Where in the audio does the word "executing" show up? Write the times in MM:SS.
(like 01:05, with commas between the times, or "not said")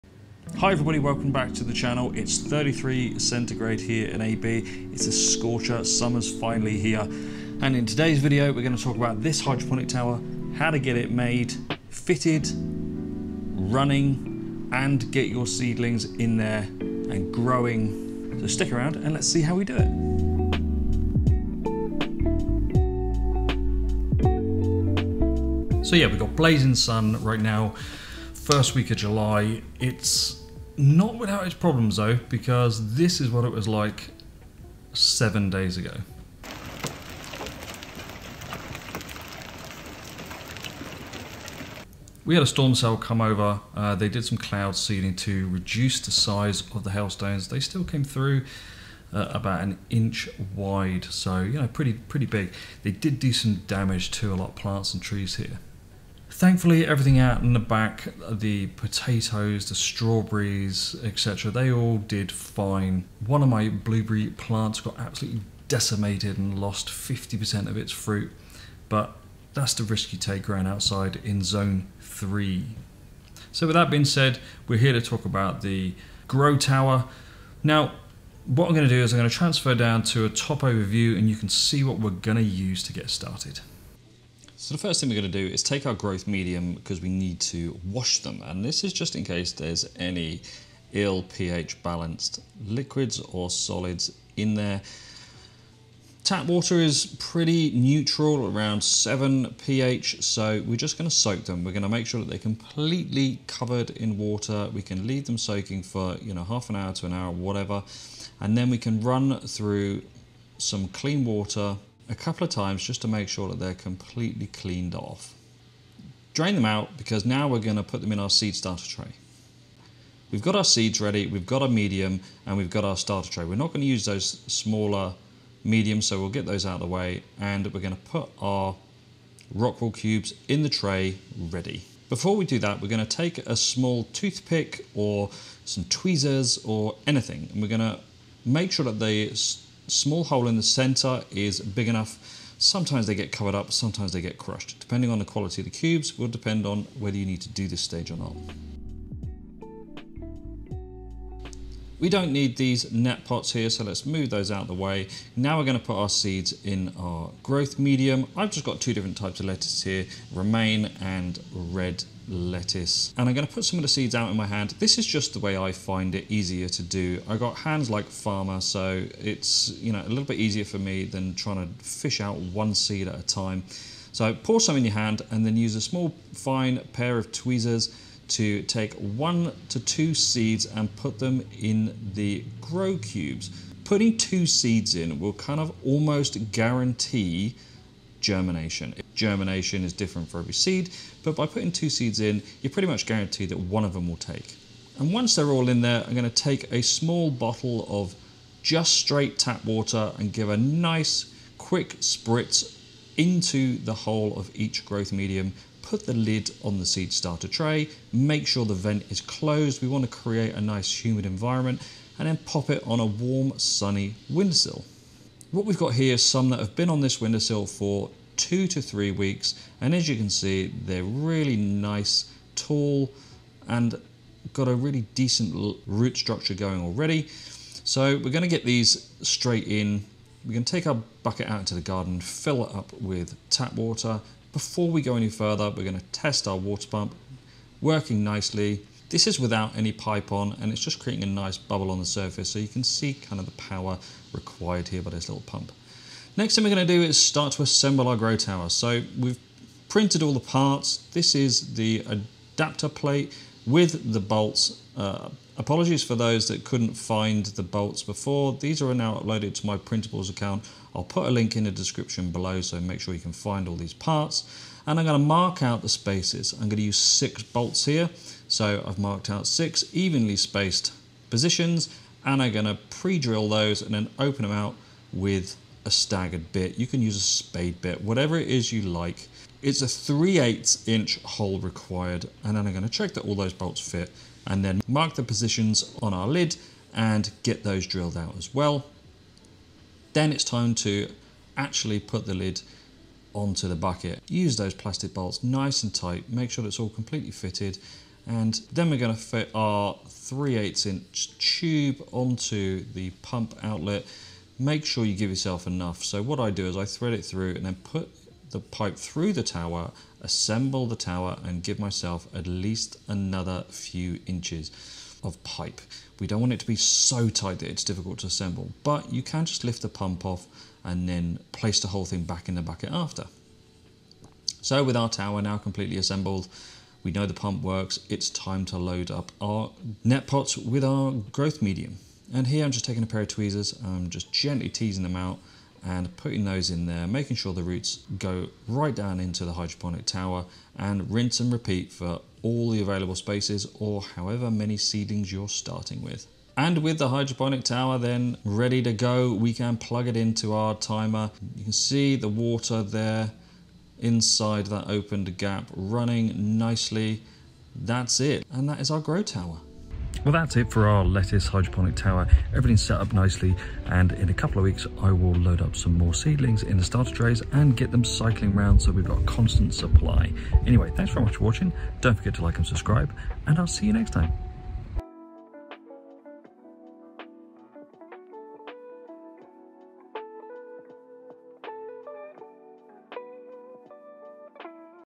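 not said.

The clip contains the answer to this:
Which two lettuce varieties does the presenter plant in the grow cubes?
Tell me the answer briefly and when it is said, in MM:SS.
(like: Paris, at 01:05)
romaine and red lettuce, at 02:40.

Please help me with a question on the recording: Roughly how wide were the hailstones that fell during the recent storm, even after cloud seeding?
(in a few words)
about an inch.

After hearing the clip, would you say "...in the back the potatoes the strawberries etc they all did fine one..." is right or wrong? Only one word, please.
right.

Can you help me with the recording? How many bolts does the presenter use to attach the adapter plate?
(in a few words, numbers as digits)
6.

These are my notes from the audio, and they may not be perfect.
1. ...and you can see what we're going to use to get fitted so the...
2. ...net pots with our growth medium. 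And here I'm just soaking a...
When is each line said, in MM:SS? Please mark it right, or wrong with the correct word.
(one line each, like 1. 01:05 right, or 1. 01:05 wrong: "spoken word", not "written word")
1. 01:21 wrong: "started", not "fitted"
2. 05:30 wrong: "taking", not "soaking".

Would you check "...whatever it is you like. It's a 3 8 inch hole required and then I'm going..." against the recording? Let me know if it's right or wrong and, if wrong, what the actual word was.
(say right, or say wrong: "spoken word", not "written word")
right.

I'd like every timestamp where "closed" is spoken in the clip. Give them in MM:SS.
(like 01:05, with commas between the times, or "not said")
03:29.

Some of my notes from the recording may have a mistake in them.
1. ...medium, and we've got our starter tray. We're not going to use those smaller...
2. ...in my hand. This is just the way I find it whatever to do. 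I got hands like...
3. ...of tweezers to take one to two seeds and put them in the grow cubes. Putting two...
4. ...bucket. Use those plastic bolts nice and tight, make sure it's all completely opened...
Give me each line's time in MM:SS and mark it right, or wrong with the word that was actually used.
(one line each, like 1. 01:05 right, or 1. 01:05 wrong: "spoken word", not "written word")
1. 02:01 right
2. 02:44 wrong: "easier", not "whatever"
3. 02:57 right
4. 04:53 wrong: "fitted", not "opened".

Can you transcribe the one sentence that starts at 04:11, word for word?
This is the adapter plate with the bolts uh, Apologies for those that couldn't find the bolts before.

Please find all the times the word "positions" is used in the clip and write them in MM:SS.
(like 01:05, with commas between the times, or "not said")
04:31, 04:45.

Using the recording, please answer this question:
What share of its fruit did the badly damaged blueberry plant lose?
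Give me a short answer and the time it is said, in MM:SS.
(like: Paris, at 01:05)
50%, at 01:06.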